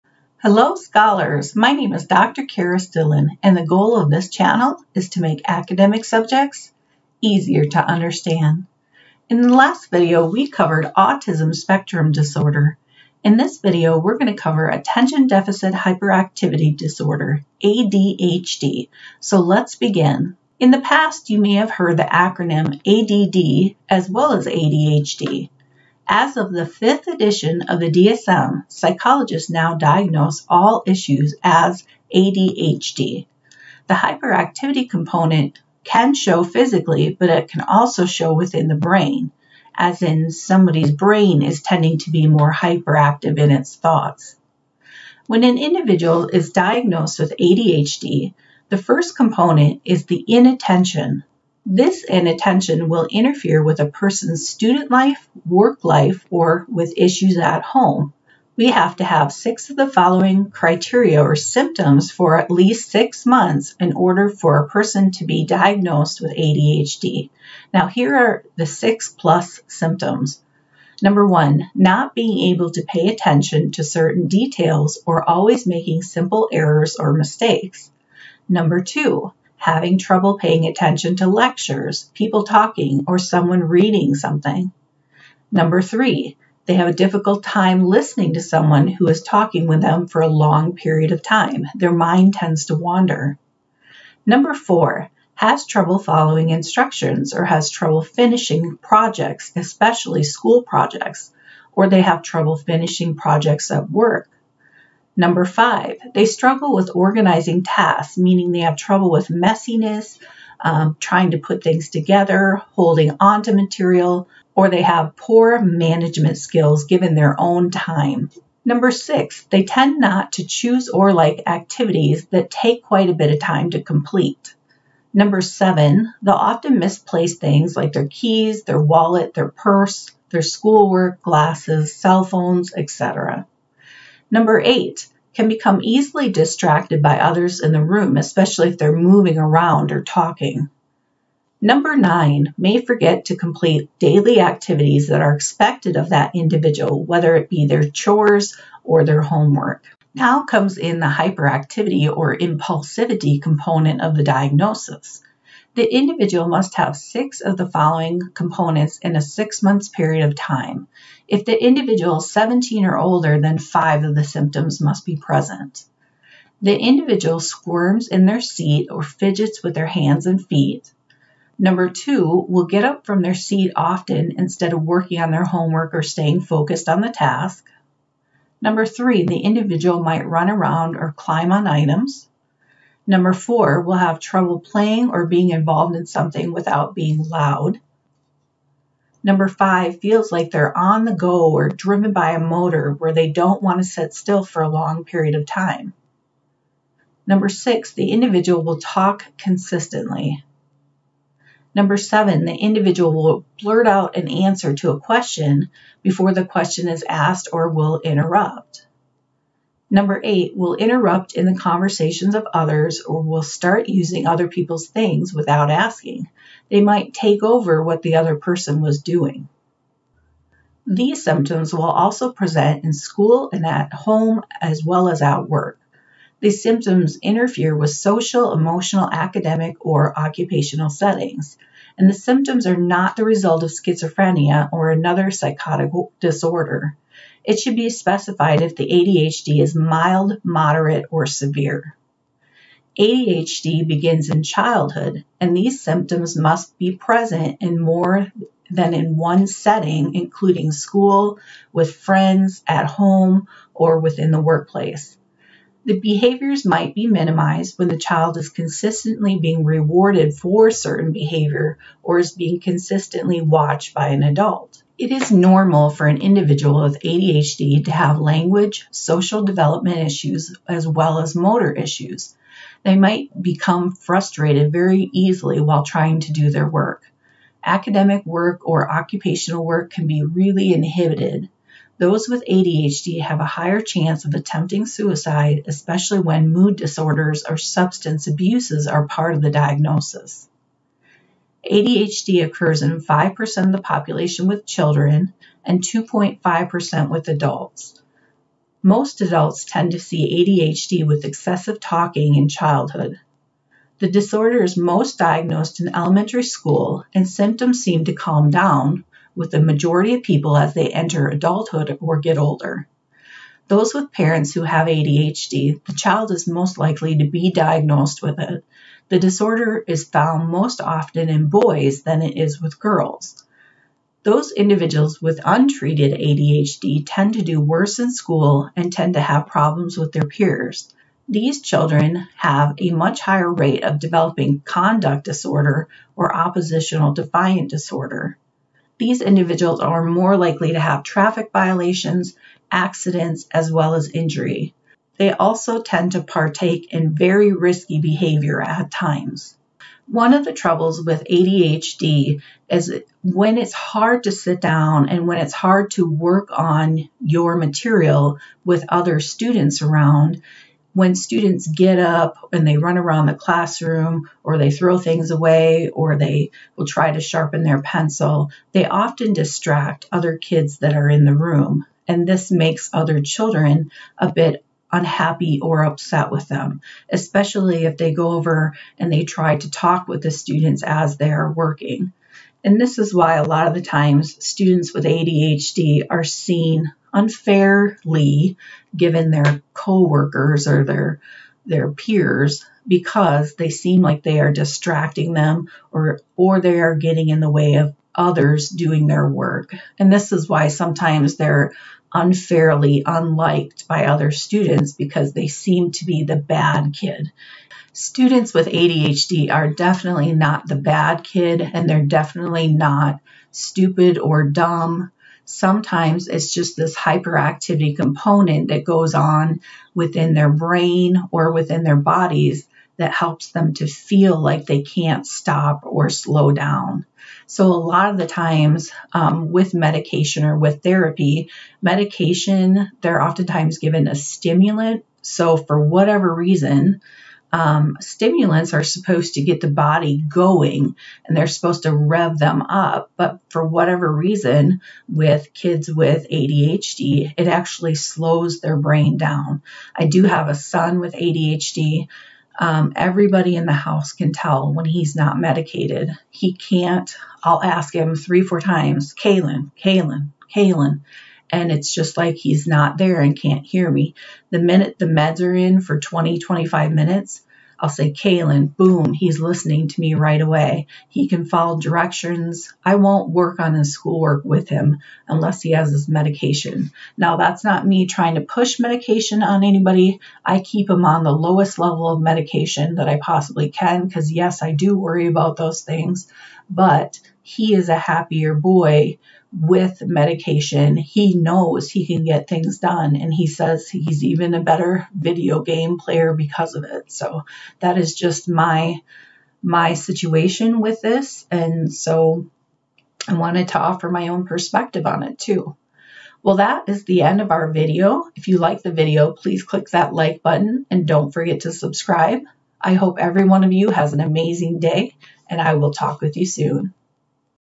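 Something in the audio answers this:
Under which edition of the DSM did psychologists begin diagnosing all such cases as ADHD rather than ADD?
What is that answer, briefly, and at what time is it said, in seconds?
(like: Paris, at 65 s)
Fifth, at 26 s.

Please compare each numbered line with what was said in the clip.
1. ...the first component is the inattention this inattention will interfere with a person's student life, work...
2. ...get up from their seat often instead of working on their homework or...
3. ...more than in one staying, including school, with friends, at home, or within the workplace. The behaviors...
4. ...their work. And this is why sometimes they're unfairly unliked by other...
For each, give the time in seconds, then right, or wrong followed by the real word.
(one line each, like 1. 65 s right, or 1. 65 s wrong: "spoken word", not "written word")
1. 48 s right
2. 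172 s right
3. 247 s wrong: "setting", not "staying"
4. 399 s right.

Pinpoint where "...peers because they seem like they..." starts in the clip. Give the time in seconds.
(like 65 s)
391 s.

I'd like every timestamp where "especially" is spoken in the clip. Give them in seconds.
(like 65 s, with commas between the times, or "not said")
99 s, 138 s, 285 s, 377 s.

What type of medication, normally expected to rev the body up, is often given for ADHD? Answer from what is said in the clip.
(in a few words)
A stimulant.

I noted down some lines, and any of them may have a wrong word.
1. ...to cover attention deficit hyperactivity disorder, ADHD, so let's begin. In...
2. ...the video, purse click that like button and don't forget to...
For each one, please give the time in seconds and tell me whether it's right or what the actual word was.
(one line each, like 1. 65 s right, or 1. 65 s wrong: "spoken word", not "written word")
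1. 14 s right
2. 508 s wrong: "please", not "purse".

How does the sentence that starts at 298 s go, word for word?
Most adults tend to see ADHD with excessive talking in childhood.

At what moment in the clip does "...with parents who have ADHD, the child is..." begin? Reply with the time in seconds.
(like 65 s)
313 s.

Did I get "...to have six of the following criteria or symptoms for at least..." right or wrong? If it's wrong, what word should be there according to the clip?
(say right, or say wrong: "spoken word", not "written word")
right.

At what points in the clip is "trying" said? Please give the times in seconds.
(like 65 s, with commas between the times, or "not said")
110 s, 275 s, 478 s.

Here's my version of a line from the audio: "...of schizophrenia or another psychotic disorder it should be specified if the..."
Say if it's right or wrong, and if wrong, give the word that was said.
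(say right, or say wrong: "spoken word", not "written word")
right.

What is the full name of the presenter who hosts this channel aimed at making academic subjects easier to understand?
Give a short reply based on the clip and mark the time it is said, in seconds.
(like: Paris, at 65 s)
Kerris Dillon, at 2 s.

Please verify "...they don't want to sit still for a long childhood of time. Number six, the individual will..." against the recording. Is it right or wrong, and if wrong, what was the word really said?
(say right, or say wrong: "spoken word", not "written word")
wrong: "period", not "childhood".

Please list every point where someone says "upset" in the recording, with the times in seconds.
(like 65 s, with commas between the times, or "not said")
375 s.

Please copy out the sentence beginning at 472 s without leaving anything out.
I won't work on his schoolwork with him unless he has his medication.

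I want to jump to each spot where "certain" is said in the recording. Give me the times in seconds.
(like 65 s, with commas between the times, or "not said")
73 s, 260 s.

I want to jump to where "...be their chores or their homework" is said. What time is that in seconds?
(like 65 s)
147 s.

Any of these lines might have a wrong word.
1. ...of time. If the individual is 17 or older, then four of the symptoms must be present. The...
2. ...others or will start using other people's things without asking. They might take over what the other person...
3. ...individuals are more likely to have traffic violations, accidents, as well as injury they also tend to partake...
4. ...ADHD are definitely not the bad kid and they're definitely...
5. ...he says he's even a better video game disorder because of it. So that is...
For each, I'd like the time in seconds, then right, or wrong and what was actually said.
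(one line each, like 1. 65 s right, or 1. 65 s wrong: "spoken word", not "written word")
1. 160 s wrong: "five", not "four"
2. 212 s right
3. 339 s right
4. 408 s right
5. 493 s wrong: "player", not "disorder".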